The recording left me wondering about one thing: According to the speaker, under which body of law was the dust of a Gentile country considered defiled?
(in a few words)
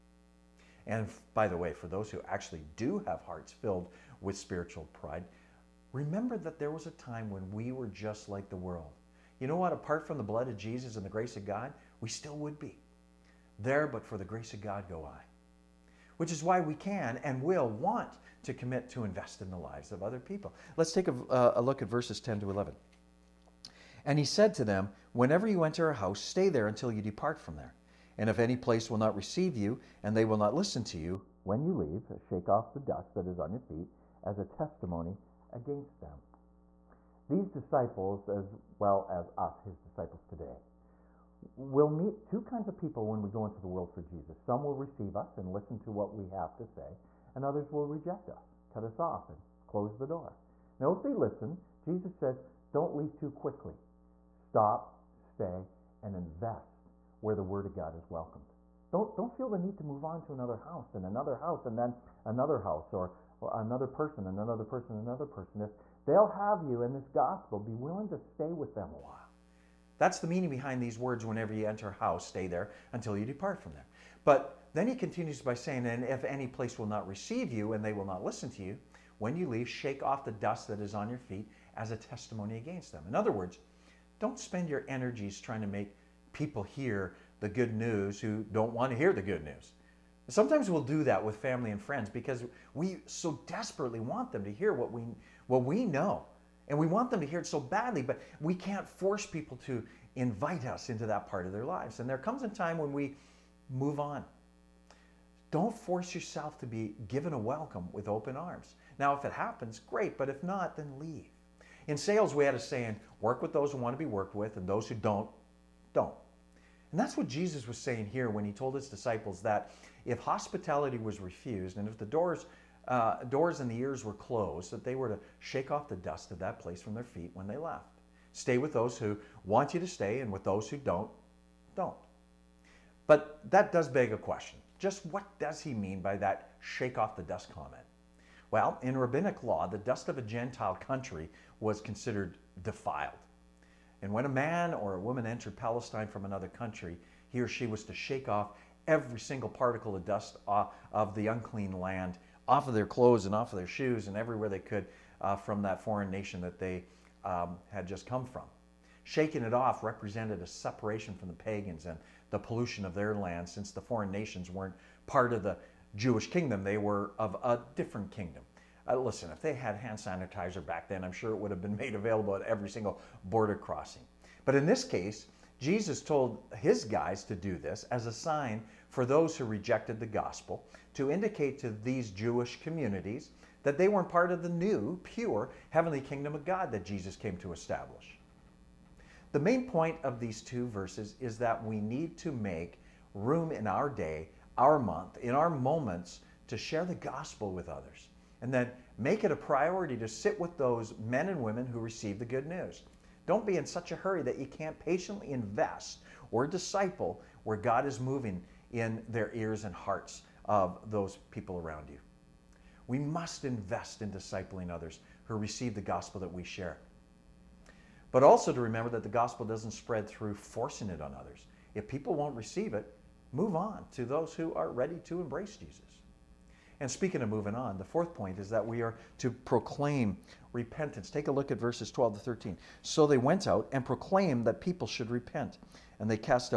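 Rabbinic law.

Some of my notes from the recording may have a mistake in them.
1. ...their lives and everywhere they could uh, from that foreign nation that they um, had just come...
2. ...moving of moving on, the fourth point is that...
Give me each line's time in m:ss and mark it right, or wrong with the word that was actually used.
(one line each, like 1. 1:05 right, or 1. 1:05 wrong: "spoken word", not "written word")
1. 2:33 wrong: "shoes", not "lives"
2. 3:46 wrong: "speaking", not "moving".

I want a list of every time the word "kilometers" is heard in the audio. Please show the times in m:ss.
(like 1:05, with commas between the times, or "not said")
not said.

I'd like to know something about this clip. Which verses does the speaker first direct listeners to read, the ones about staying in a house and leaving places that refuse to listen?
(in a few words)
10 to 11.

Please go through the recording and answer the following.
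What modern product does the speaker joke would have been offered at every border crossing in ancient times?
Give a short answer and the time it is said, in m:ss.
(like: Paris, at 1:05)
Hand sanitizer, at 2:49.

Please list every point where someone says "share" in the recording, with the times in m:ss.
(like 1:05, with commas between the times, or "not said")
3:16, 3:36.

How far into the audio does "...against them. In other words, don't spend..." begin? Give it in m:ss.
1:22.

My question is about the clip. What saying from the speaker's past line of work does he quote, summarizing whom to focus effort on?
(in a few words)
Work with those who want to be worked with.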